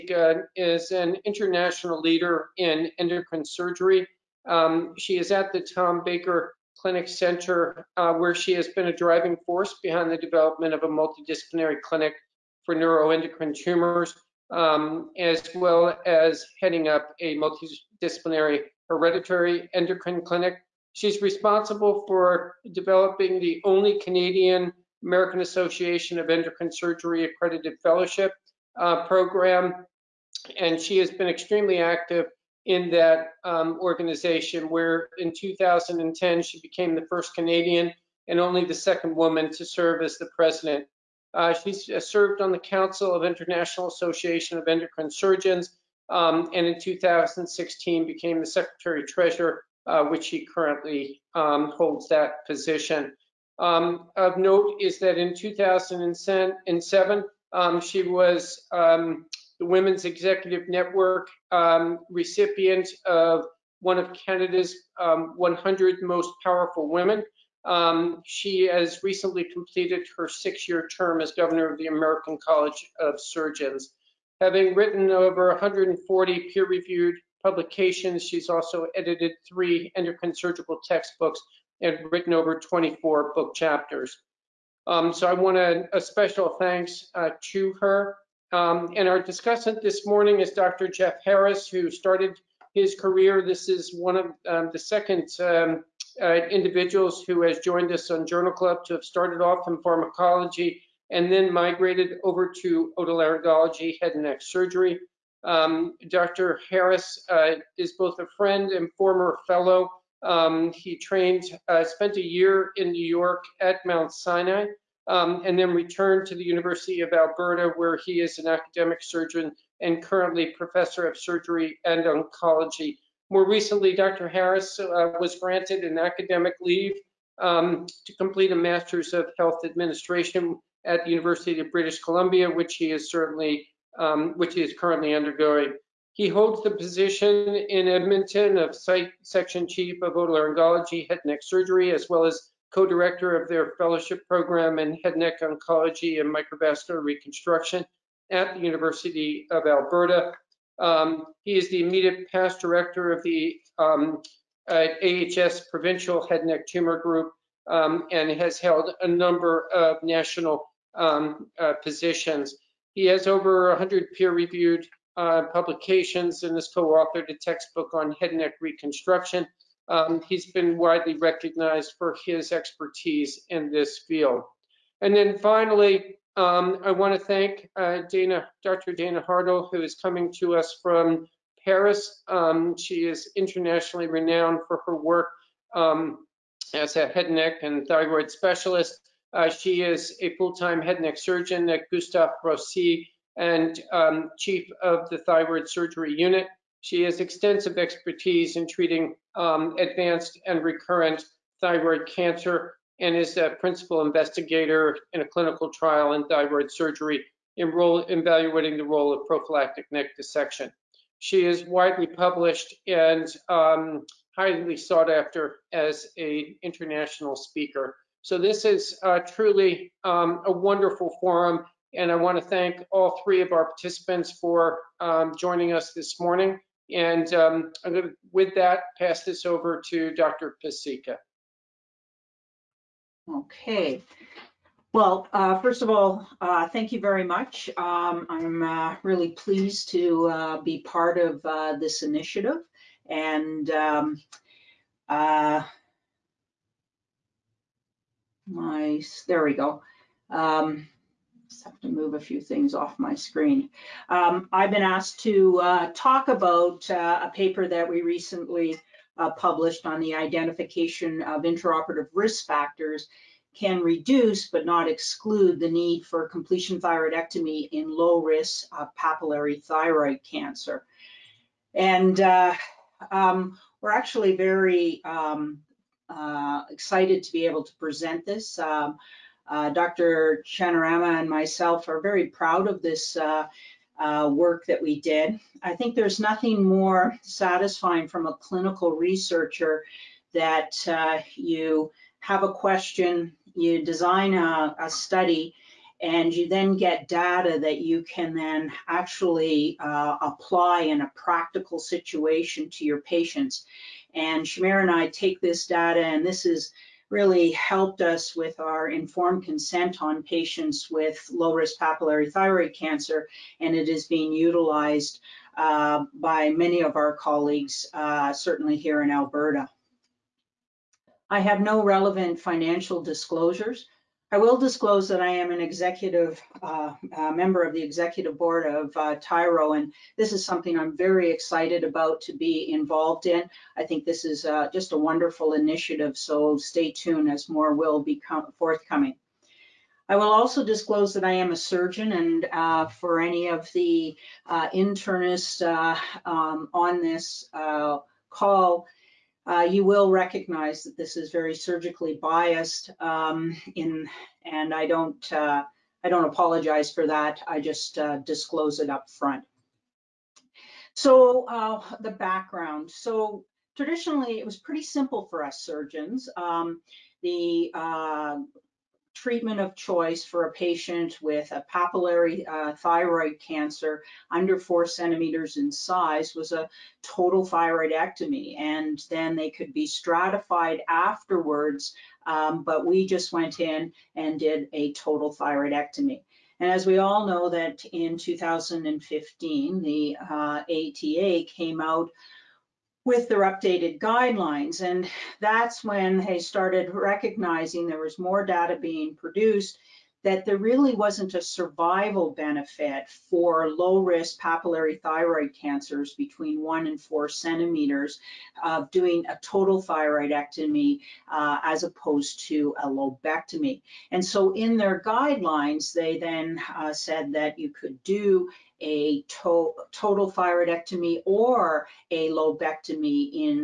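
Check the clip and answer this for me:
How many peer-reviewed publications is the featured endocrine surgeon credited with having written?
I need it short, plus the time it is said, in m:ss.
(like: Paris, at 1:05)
over 140, at 1:15.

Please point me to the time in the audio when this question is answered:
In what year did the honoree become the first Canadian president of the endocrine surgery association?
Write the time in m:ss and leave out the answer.
0:35.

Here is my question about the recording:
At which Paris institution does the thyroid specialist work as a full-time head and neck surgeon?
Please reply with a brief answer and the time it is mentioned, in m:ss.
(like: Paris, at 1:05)
Gustave Roussy, at 3:11.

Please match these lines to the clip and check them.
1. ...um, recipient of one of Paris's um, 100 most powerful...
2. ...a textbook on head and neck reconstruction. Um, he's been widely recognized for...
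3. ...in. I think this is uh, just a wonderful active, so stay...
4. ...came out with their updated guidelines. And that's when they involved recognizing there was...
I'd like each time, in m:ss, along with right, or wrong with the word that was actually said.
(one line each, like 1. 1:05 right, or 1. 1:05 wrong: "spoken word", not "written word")
1. 1:01 wrong: "Canada", not "Paris"
2. 2:47 right
3. 5:33 wrong: "initiative", not "active"
4. 6:31 wrong: "started", not "involved".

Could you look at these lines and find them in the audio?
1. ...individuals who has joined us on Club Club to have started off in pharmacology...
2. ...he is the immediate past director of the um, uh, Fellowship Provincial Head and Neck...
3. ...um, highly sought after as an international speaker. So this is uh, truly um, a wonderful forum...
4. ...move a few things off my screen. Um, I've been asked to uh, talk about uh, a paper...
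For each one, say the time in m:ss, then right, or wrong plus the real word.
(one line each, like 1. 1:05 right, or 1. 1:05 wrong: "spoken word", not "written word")
1. 1:36 wrong: "Journal", not "Club"
2. 2:31 wrong: "AHS", not "Fellowship"
3. 3:33 right
4. 4:11 right.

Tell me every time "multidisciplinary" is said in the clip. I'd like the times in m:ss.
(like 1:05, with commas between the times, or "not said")
0:10, 0:17.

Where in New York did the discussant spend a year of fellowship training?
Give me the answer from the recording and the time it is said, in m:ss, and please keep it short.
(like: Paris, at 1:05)
Mount Sinai, at 1:53.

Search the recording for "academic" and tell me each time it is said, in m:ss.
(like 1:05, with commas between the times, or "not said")
1:58, 2:05.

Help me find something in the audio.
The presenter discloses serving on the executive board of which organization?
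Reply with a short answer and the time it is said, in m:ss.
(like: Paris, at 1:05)
Tyro, at 5:29.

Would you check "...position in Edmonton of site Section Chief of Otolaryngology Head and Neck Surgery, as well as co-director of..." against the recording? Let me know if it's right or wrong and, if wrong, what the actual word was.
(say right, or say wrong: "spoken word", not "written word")
right.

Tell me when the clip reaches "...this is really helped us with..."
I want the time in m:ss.
5:06.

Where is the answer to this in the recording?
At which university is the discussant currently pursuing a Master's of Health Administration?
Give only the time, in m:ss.
2:11.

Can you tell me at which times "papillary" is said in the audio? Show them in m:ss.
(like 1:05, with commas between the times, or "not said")
4:29, 5:11, 6:11, 6:44.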